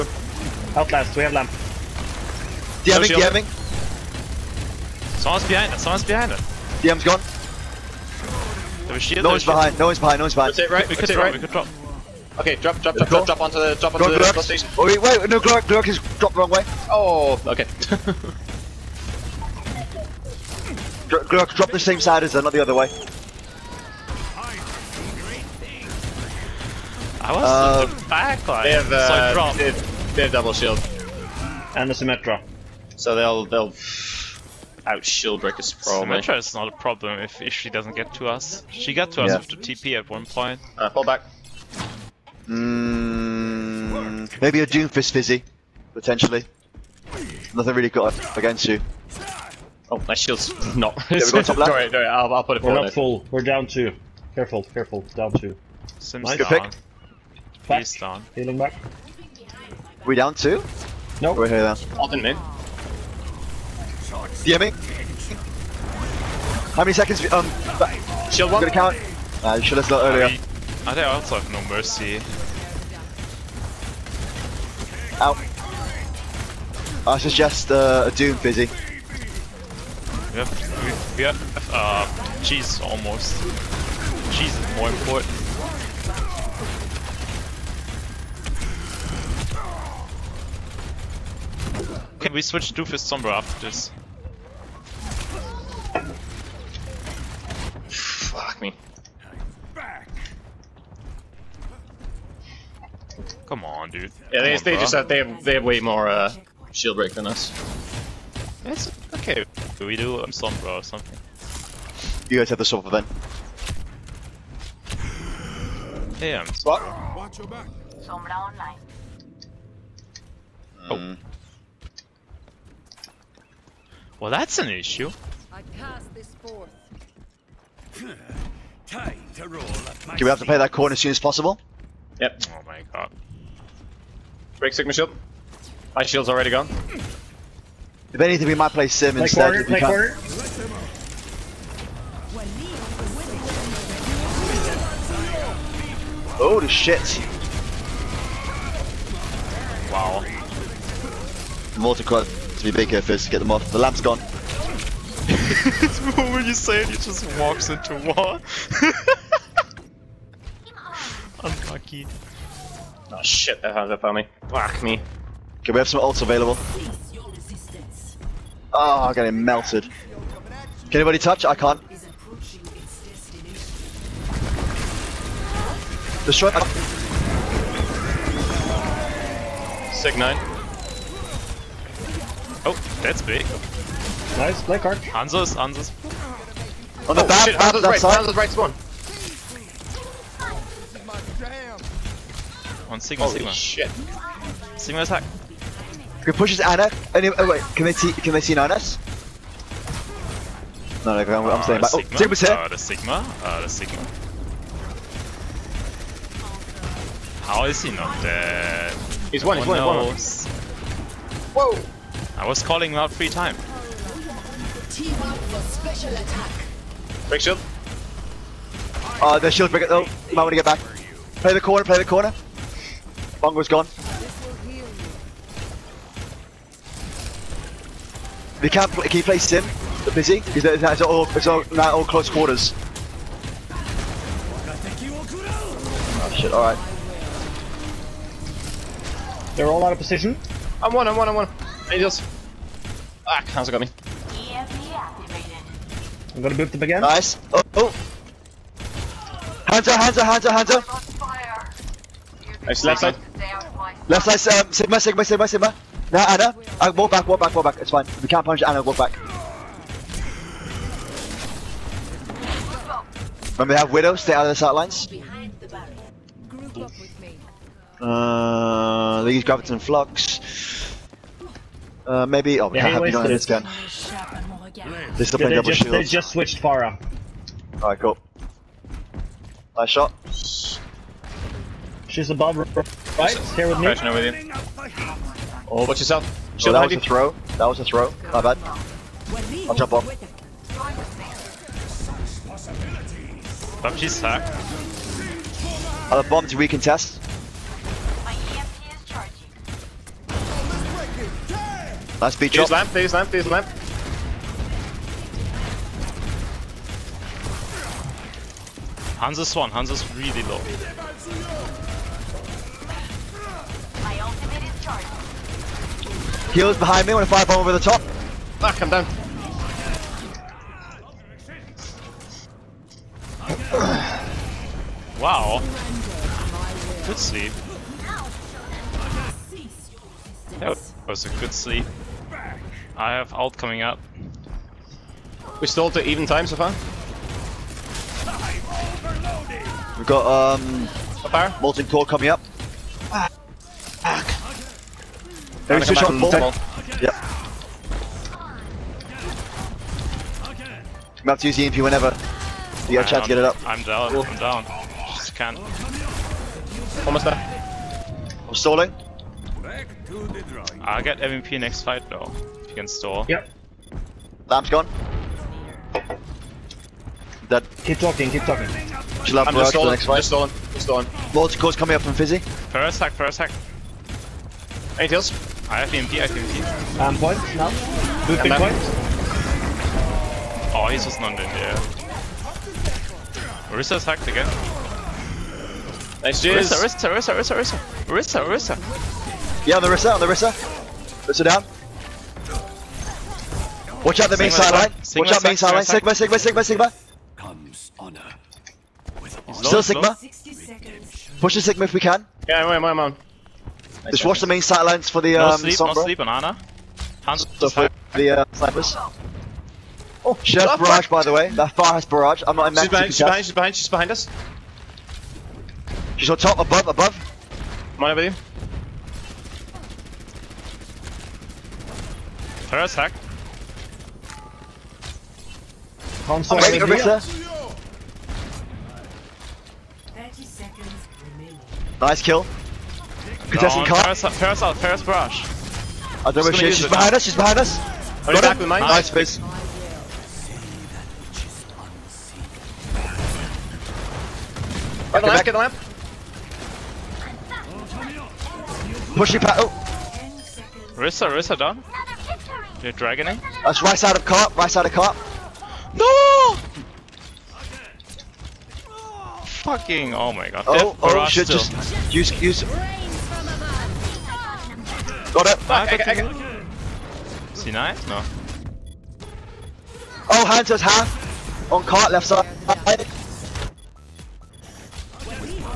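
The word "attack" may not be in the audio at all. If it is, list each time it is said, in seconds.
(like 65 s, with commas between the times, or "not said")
195 s, 216 s.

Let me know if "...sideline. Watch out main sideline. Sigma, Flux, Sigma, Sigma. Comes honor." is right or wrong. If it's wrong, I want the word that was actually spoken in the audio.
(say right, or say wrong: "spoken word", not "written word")
wrong: "Sigma", not "Flux".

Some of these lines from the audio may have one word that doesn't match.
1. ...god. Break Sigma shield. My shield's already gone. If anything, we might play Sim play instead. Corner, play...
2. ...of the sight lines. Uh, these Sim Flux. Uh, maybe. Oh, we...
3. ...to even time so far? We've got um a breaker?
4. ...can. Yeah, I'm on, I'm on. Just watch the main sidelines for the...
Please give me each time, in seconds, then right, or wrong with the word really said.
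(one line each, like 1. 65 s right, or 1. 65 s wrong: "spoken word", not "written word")
1. 132 s right
2. 264 s wrong: "Graviton", not "Sim"
3. 335 s wrong: "power", not "breaker"
4. 402 s right.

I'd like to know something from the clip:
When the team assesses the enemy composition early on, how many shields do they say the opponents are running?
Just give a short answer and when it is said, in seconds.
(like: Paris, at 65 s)
double shield, at 30 s.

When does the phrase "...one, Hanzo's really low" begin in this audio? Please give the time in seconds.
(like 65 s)
309 s.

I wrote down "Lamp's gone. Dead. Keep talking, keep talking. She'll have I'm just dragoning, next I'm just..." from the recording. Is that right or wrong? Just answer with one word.
wrong.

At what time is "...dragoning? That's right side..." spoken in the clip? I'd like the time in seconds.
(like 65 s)
452 s.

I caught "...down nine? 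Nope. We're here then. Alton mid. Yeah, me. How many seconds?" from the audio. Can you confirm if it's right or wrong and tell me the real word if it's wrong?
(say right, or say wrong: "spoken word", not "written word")
wrong: "two", not "nine".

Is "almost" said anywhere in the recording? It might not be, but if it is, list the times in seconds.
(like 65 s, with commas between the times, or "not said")
82 s, 357 s.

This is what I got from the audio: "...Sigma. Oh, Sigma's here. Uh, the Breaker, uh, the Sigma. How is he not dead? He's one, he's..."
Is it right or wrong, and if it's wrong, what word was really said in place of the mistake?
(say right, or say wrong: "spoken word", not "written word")
wrong: "Sigma", not "Breaker".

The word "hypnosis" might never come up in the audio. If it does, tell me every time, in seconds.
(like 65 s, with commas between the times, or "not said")
not said.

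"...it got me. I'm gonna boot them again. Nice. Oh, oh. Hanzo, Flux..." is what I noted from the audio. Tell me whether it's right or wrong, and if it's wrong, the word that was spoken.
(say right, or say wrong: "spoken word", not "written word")
wrong: "Hanzo", not "Flux".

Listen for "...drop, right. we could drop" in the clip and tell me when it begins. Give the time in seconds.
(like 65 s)
11 s.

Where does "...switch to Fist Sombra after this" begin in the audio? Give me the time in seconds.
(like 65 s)
92 s.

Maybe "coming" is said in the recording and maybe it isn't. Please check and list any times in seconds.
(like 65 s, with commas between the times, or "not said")
333 s, 342 s, 371 s.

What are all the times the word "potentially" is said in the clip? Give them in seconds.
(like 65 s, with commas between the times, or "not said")
45 s.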